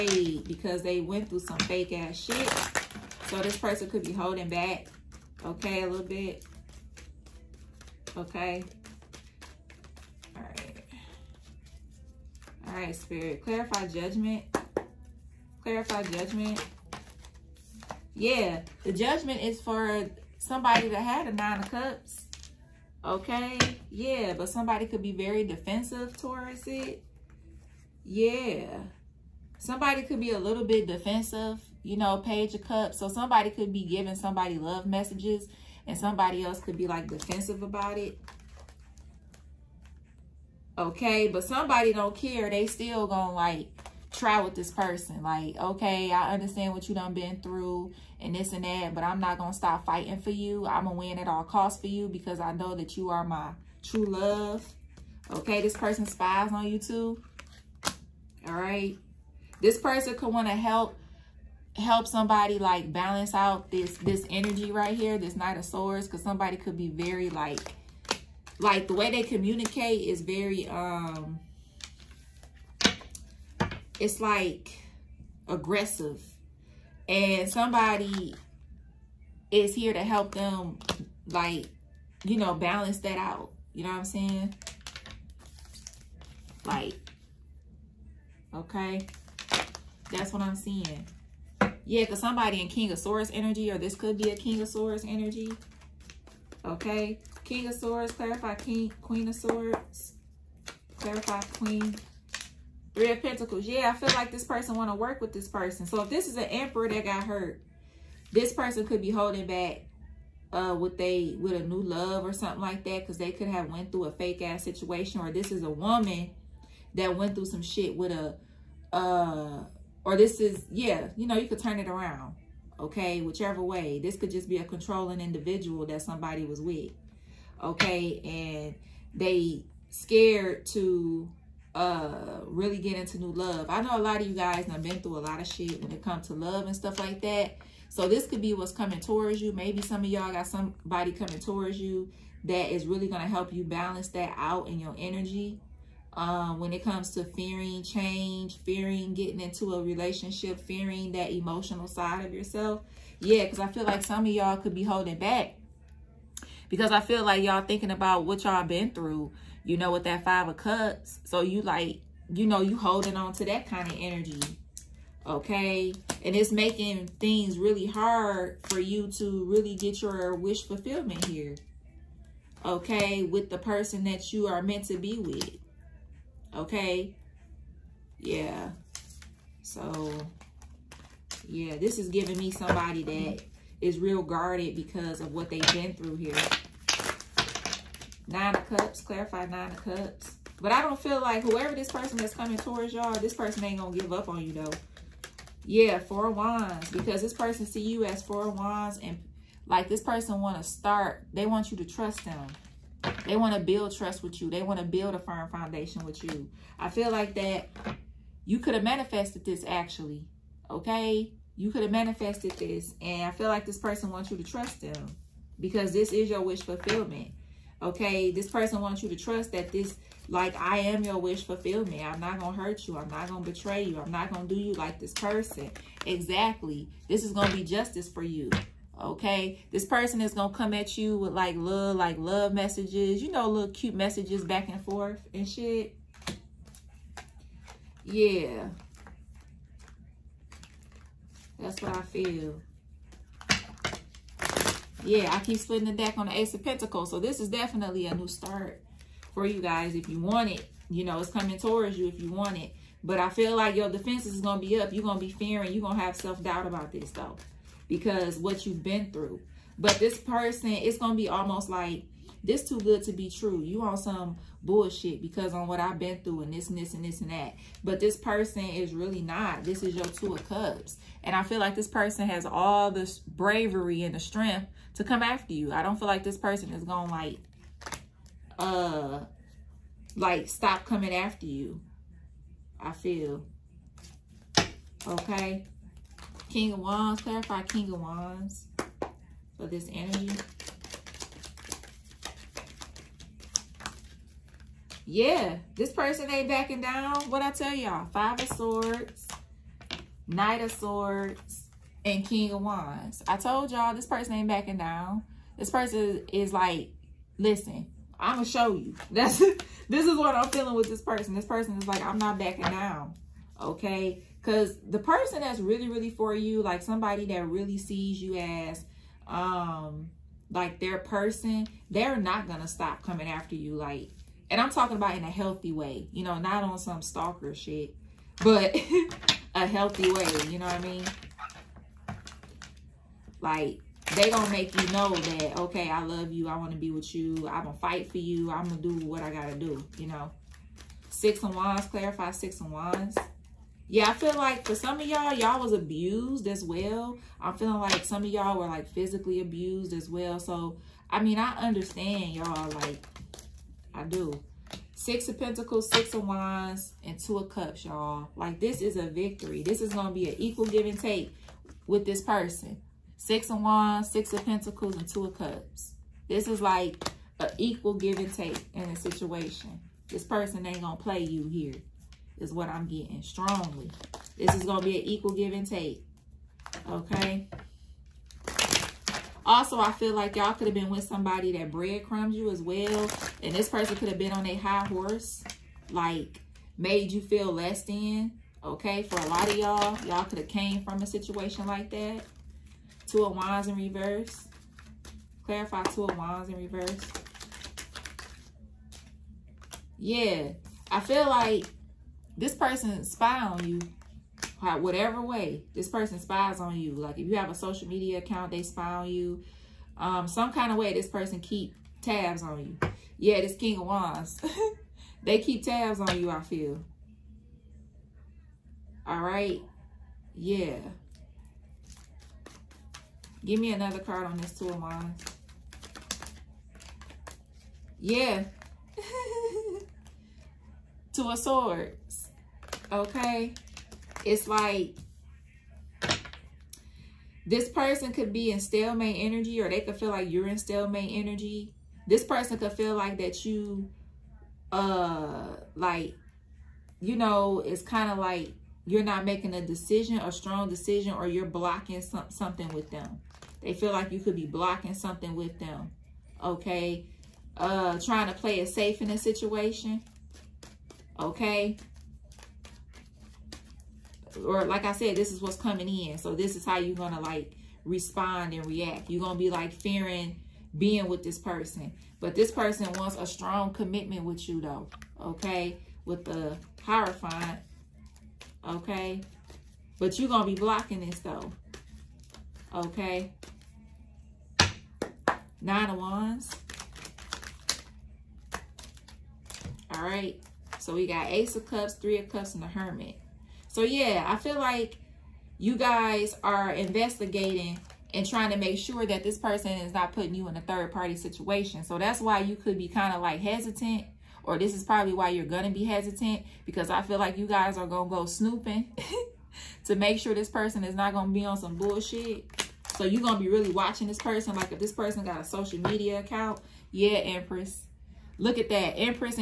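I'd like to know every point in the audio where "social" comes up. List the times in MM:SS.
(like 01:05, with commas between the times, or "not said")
06:47, 08:35.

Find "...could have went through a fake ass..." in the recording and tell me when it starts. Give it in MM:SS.
01:53.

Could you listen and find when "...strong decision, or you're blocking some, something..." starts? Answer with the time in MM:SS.
07:30.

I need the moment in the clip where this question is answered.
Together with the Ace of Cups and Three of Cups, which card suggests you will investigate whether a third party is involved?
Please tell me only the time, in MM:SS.
08:12.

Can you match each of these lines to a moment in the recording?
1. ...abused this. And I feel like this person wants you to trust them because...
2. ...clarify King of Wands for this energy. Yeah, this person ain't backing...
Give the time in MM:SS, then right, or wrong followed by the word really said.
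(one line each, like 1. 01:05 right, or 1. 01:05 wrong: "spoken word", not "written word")
1. 03:31 wrong: "manifested", not "abused"
2. 04:47 right.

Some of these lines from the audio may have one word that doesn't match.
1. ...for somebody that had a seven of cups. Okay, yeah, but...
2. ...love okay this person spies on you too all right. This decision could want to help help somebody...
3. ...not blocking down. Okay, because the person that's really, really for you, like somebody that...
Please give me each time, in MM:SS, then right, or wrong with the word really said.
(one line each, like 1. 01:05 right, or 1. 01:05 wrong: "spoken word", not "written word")
1. 00:19 wrong: "nine", not "seven"
2. 00:54 wrong: "person", not "decision"
3. 05:12 wrong: "backing", not "blocking".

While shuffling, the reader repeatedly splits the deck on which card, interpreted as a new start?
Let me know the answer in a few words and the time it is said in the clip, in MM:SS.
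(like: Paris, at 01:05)
Ace of Pentacles, at 04:06.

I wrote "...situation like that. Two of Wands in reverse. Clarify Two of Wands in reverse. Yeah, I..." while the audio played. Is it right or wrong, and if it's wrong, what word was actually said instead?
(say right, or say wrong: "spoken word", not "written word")
right.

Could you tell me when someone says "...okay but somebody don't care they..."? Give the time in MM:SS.
00:40.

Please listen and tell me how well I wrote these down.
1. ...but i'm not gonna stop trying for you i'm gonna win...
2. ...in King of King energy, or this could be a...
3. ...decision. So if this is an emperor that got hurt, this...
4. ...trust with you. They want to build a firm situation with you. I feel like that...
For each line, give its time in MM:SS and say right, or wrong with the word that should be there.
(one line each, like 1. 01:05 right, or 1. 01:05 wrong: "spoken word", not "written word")
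1. 00:48 wrong: "fighting", not "trying"
2. 01:32 wrong: "Swords", not "King"
3. 01:45 wrong: "person", not "decision"
4. 03:23 wrong: "foundation", not "situation".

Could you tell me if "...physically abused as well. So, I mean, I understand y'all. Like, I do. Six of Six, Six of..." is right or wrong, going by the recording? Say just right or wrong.
wrong.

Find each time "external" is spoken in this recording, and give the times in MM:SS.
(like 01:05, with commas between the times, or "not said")
not said.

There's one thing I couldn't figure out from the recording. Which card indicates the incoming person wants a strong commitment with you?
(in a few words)
The Hierophant.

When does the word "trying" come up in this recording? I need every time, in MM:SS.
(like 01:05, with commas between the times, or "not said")
07:37, 08:18.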